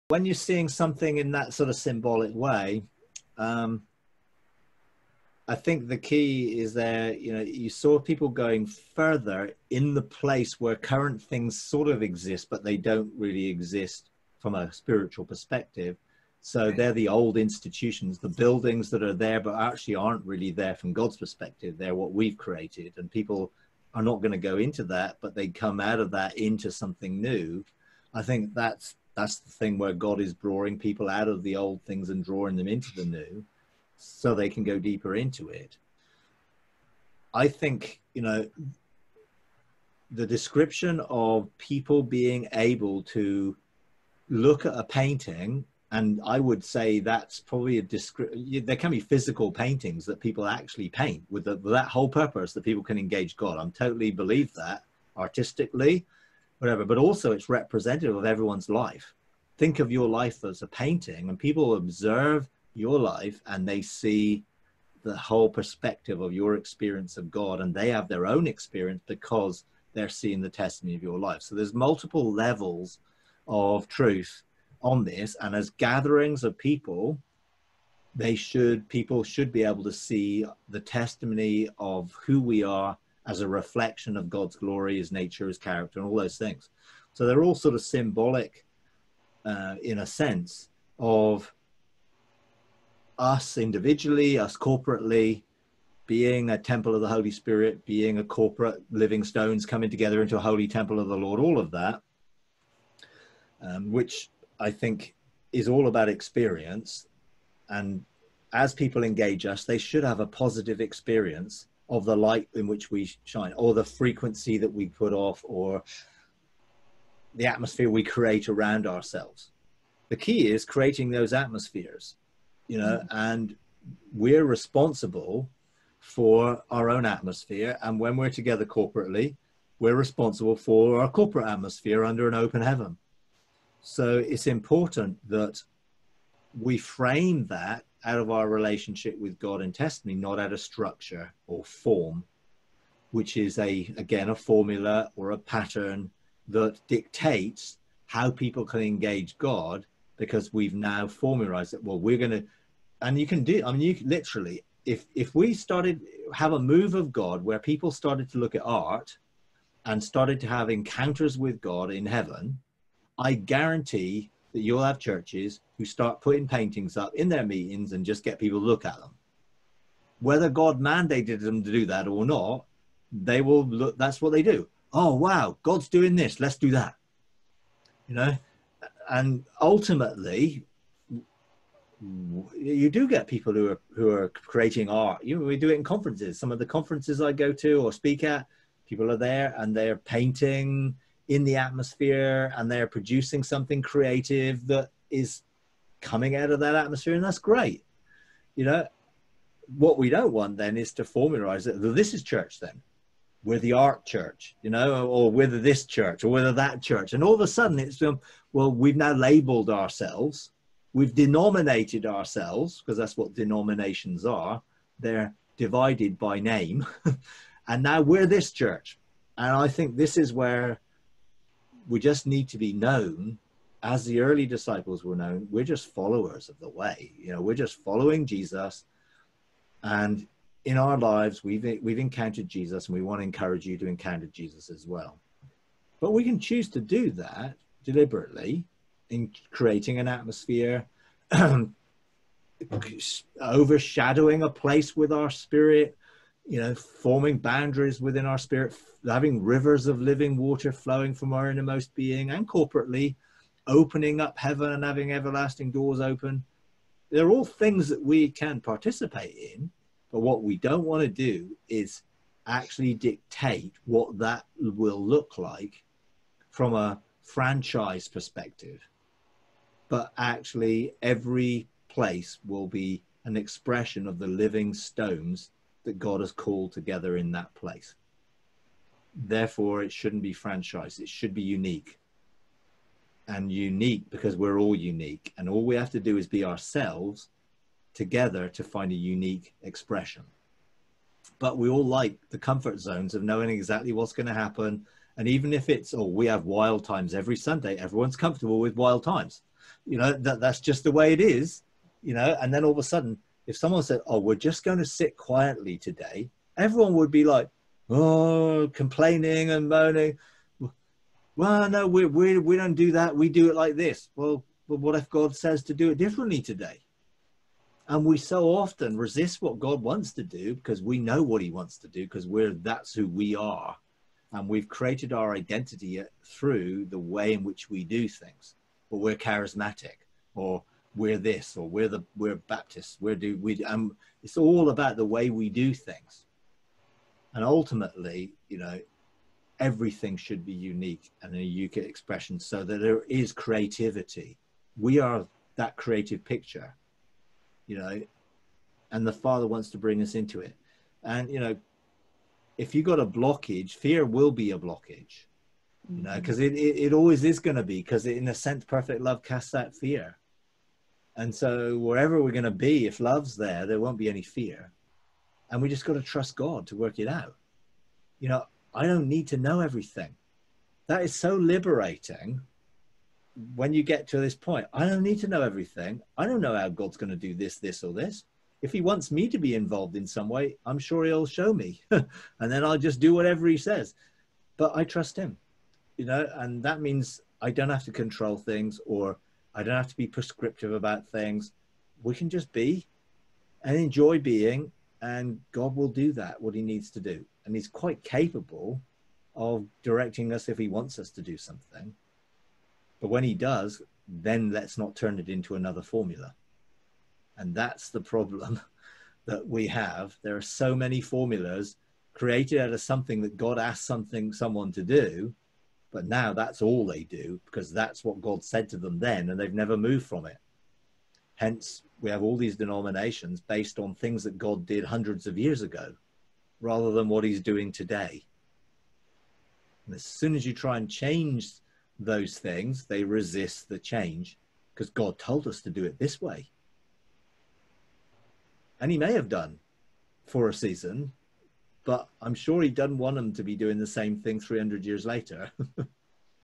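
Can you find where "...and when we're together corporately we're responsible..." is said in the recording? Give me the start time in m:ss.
2:07.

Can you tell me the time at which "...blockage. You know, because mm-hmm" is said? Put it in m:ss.
5:54.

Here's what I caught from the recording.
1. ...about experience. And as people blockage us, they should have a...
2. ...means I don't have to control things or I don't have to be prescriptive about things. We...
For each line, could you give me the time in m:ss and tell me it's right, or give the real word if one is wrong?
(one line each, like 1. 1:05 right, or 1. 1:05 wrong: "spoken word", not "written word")
1. 1:45 wrong: "engage", not "blockage"
2. 6:26 right.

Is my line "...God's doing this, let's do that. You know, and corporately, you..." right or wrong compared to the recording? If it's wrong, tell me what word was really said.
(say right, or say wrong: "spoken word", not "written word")
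wrong: "ultimately", not "corporately".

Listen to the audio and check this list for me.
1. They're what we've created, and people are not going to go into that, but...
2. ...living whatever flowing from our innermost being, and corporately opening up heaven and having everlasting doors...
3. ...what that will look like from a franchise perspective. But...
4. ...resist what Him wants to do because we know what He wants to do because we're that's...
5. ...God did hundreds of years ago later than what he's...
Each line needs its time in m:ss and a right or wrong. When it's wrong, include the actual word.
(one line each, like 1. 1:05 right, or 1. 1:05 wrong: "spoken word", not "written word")
1. 0:21 right
2. 4:10 wrong: "water", not "whatever"
3. 4:23 right
4. 5:18 wrong: "God", not "Him"
5. 7:04 wrong: "rather", not "later".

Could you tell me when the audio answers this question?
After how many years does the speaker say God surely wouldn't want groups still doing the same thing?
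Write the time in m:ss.
7:24.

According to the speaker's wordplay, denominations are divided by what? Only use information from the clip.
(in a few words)
Name.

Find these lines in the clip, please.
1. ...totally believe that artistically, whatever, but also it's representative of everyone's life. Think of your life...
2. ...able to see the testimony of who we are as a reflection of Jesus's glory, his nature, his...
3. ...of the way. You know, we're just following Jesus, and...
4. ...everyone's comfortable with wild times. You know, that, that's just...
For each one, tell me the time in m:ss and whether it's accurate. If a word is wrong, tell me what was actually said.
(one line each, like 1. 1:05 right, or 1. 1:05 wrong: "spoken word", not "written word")
1. 0:53 right
2. 1:19 wrong: "God", not "Jesus"
3. 3:46 right
4. 4:57 right.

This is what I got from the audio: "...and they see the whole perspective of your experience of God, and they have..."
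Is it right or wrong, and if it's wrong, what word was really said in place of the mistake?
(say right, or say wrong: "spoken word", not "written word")
right.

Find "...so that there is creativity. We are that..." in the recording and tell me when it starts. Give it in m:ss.
5:42.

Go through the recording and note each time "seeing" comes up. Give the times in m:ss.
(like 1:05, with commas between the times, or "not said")
0:00, 1:10.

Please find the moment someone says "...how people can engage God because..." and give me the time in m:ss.
2:28.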